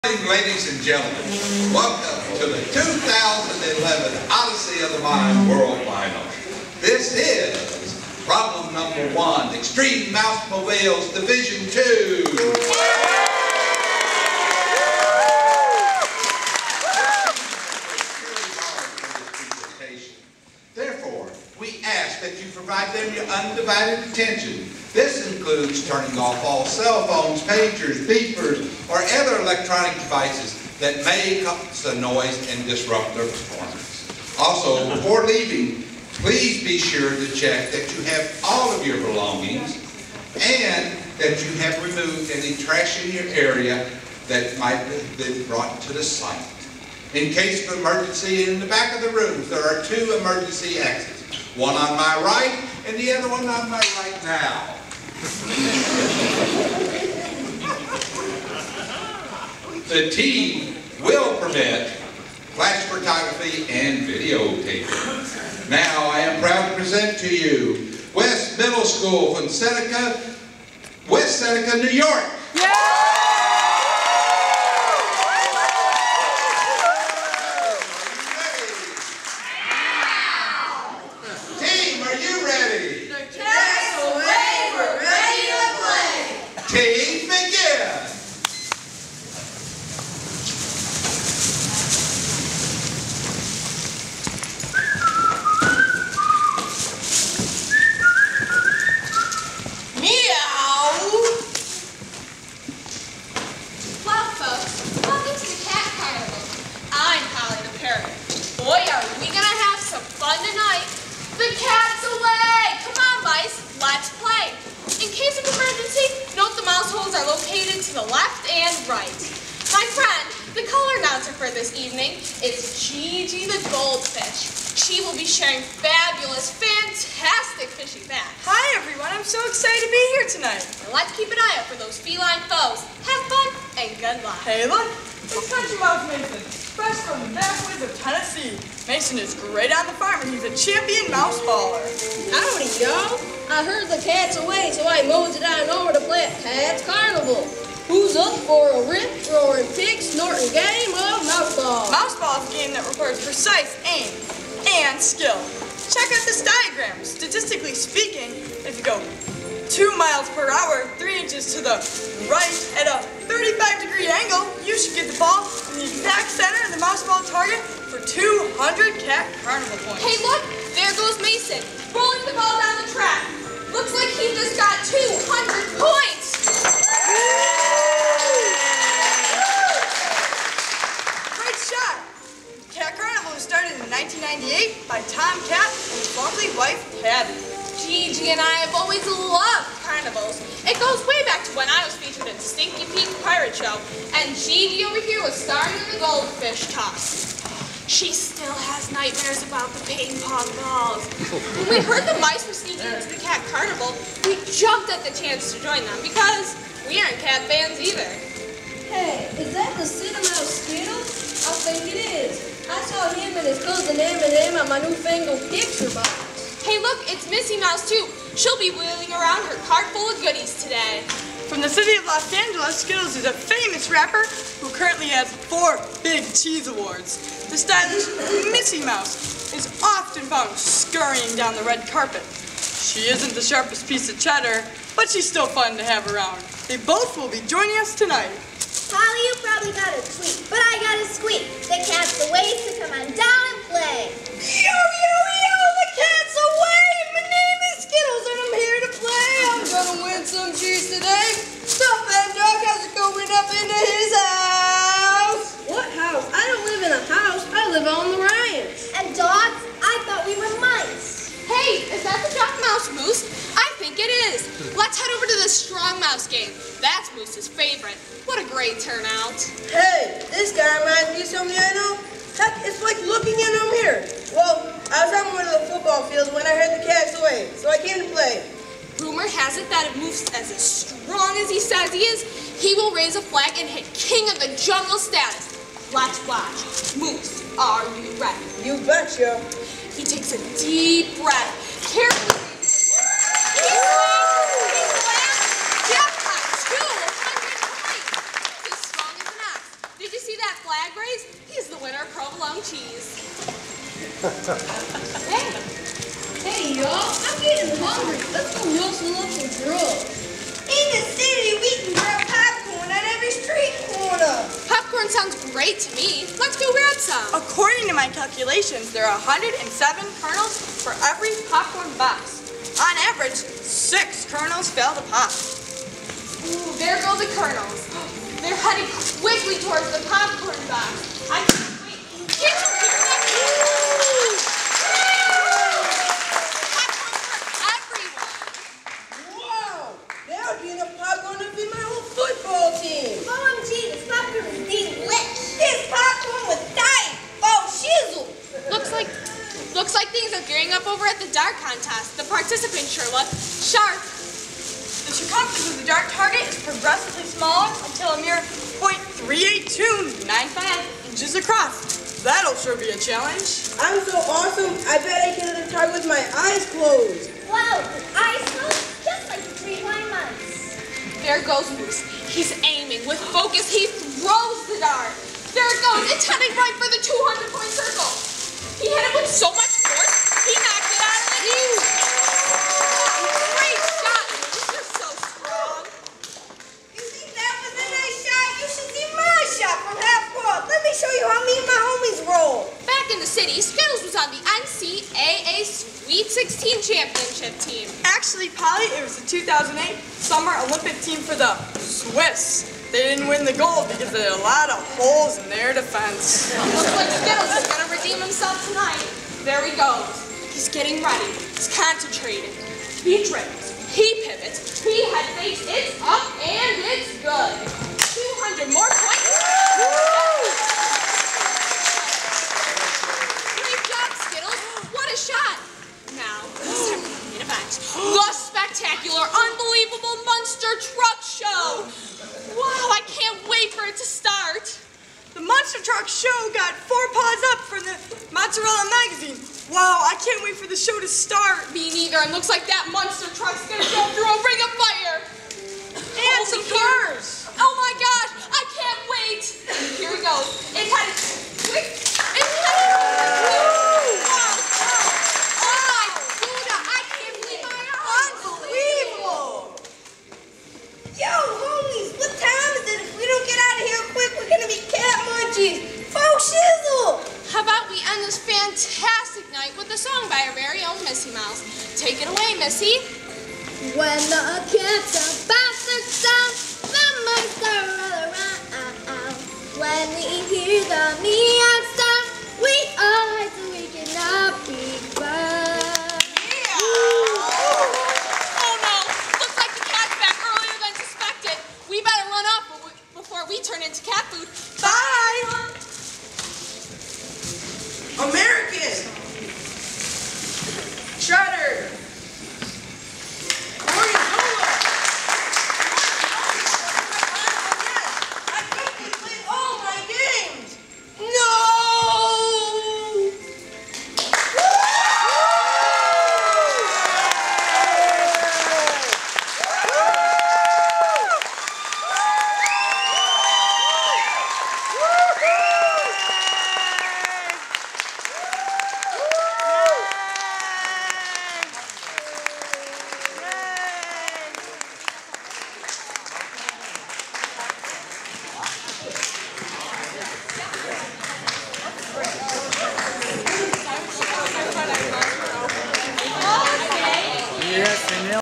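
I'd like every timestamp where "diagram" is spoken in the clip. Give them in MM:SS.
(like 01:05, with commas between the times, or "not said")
02:36.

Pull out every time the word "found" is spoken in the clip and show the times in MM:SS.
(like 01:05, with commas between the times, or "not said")
03:50, 08:05.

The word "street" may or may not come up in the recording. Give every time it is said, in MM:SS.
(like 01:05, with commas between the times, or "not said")
05:13.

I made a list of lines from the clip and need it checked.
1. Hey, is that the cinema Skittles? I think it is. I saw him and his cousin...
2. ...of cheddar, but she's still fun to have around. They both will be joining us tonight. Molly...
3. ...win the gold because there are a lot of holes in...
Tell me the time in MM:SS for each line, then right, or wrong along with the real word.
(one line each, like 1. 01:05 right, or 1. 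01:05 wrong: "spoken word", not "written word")
1. 03:28 right
2. 03:54 right
3. 06:43 right.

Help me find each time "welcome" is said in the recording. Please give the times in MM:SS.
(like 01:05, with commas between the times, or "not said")
00:01.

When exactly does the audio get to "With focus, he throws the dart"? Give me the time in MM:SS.
06:13.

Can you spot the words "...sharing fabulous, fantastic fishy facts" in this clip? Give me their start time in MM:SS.
02:05.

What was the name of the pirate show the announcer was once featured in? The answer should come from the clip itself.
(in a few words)
Stinky Pete's Pirate Show.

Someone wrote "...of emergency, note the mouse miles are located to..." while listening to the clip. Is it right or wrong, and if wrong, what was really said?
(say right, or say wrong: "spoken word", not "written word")
wrong: "holes", not "miles".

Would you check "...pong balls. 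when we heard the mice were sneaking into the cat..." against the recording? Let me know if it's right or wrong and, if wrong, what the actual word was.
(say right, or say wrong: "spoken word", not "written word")
right.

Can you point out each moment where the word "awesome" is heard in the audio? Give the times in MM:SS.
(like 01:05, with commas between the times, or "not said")
06:04.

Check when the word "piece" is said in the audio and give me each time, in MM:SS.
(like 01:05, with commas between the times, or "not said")
03:53.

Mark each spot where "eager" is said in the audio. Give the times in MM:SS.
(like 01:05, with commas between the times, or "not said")
not said.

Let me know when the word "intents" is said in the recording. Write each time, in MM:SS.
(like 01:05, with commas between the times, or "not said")
not said.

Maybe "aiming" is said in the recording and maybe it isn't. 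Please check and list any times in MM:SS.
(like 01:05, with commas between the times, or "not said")
06:12.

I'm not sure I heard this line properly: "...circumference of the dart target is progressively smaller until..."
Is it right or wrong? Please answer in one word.
right.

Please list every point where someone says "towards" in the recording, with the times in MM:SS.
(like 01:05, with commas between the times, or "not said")
05:29.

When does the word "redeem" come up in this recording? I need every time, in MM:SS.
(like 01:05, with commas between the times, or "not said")
06:47.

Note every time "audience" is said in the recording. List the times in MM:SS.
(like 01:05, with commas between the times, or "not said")
not said.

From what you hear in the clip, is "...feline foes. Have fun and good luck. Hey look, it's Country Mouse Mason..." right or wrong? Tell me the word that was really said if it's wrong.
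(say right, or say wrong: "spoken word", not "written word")
right.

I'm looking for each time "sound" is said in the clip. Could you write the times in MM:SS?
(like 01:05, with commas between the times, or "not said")
05:15, 07:56, 08:01.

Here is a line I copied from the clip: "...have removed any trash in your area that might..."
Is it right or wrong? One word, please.
right.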